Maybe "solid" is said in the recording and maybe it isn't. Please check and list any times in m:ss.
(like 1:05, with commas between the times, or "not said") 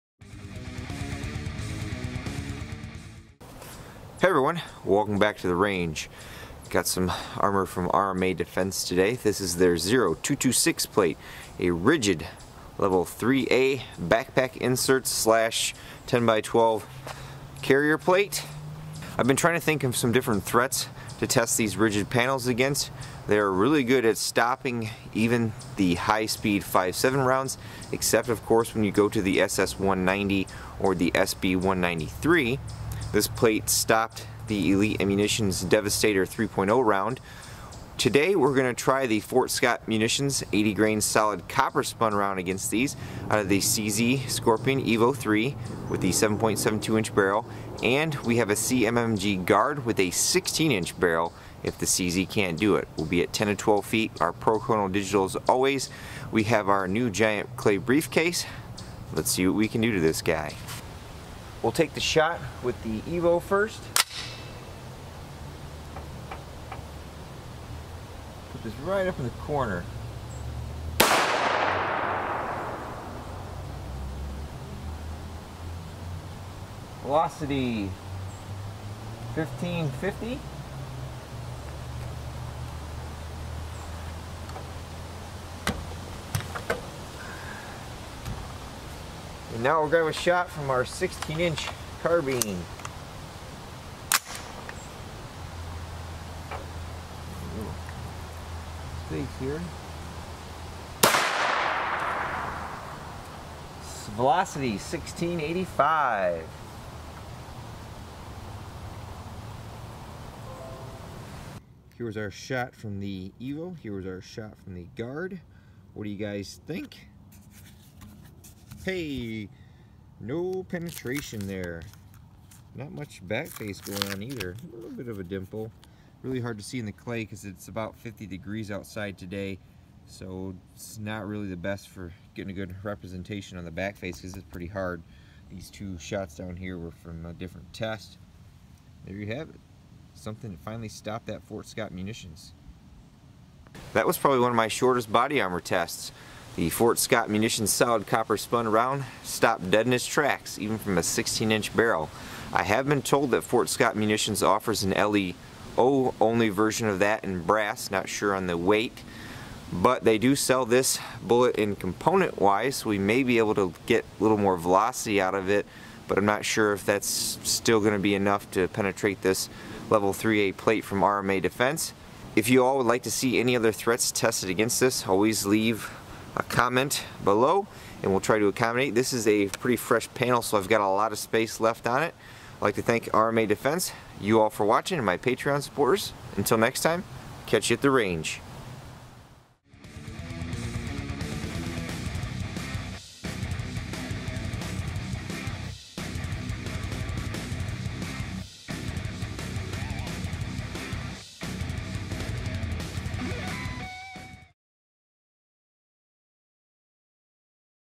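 0:41, 2:27.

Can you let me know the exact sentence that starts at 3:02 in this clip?
I'd like to thank RMA Defense, you all for watching, and my Patreon supporters.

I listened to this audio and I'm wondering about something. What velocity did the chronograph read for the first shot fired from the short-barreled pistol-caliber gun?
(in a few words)
1550.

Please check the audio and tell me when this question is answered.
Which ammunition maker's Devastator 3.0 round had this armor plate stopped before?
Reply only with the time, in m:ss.
0:34.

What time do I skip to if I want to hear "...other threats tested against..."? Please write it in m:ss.
2:53.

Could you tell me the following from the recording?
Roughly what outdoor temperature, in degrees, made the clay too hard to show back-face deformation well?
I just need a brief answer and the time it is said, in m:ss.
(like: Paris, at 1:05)
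50 degrees, at 2:07.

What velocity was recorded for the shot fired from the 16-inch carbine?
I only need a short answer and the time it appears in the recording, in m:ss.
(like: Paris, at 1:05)
1685, at 1:44.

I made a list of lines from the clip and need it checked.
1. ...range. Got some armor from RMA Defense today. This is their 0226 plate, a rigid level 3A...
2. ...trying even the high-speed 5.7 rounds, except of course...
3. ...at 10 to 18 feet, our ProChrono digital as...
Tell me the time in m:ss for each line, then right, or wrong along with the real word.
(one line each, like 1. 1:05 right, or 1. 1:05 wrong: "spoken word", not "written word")
1. 0:05 right
2. 0:24 wrong: "stopping", not "trying"
3. 0:53 wrong: "12", not "18".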